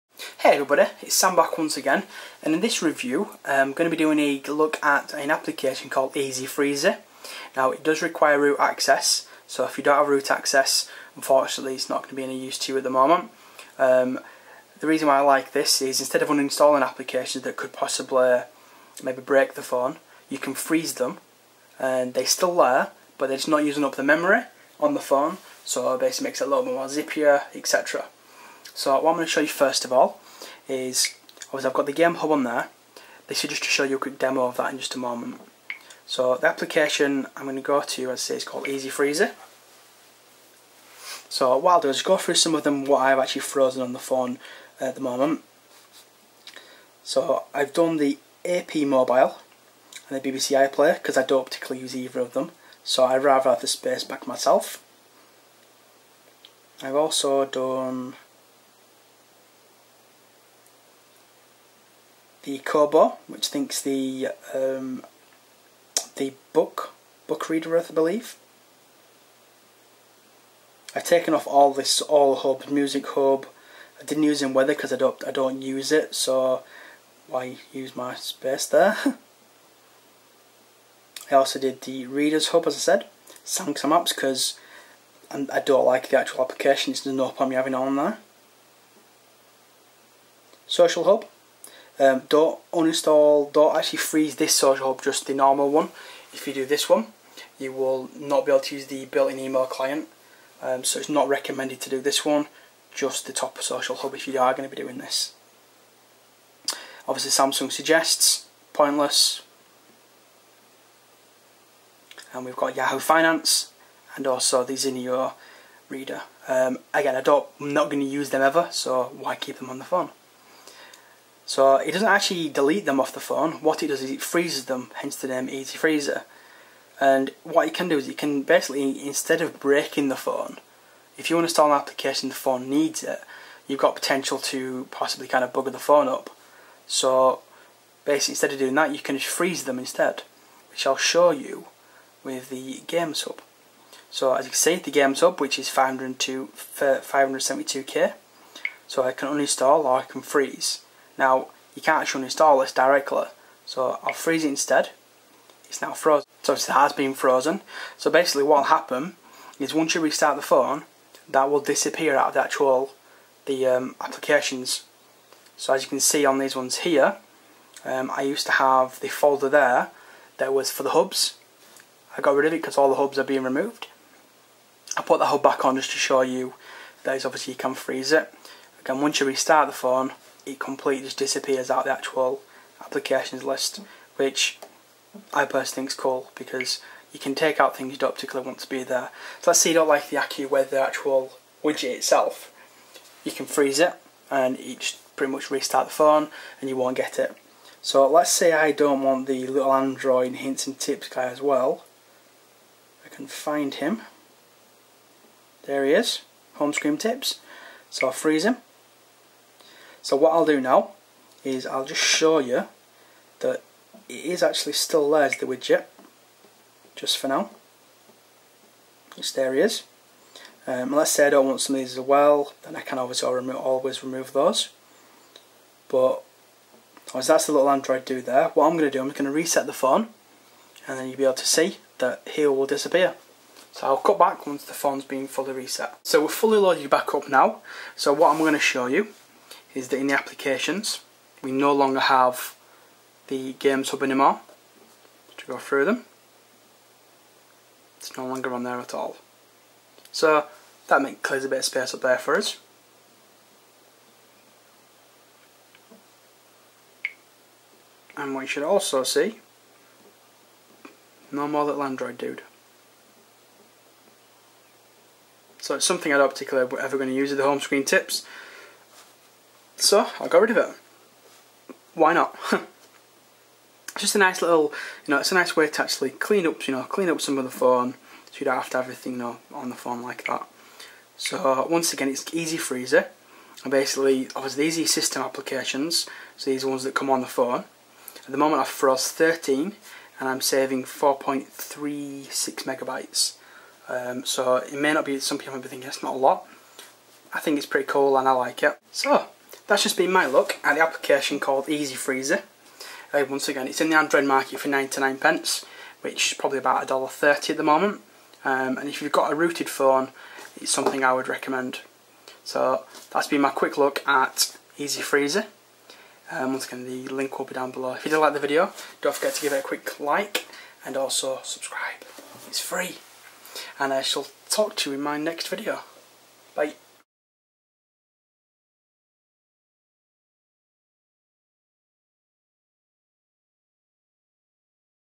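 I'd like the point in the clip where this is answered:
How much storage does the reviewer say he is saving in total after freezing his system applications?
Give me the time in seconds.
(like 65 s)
290 s.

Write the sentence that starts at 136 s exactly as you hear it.
So basically instead of doing that you can just freeze them instead, which I'll show you with the Games Hub.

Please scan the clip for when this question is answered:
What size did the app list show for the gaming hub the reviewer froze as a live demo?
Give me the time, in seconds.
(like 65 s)
146 s.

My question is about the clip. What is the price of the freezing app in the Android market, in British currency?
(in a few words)
99 pence.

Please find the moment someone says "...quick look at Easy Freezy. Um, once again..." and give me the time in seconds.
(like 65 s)
313 s.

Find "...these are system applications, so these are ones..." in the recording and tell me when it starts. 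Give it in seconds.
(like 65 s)
284 s.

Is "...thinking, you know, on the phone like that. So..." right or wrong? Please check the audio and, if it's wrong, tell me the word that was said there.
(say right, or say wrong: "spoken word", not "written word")
wrong: "everything", not "thinking".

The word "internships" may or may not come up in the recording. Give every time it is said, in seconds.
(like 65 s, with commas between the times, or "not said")
not said.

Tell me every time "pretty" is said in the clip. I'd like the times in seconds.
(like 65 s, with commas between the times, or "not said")
195 s, 297 s.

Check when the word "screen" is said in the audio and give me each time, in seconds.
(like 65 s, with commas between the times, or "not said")
206 s, 267 s.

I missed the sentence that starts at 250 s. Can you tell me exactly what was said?
So that makes clears a bit of space up there for us.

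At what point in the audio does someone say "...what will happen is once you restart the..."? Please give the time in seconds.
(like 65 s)
158 s.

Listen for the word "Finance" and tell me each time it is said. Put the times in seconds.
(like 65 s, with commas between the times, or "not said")
112 s.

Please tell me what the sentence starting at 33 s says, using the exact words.
This is just to show you a quick demo of that in just a moment.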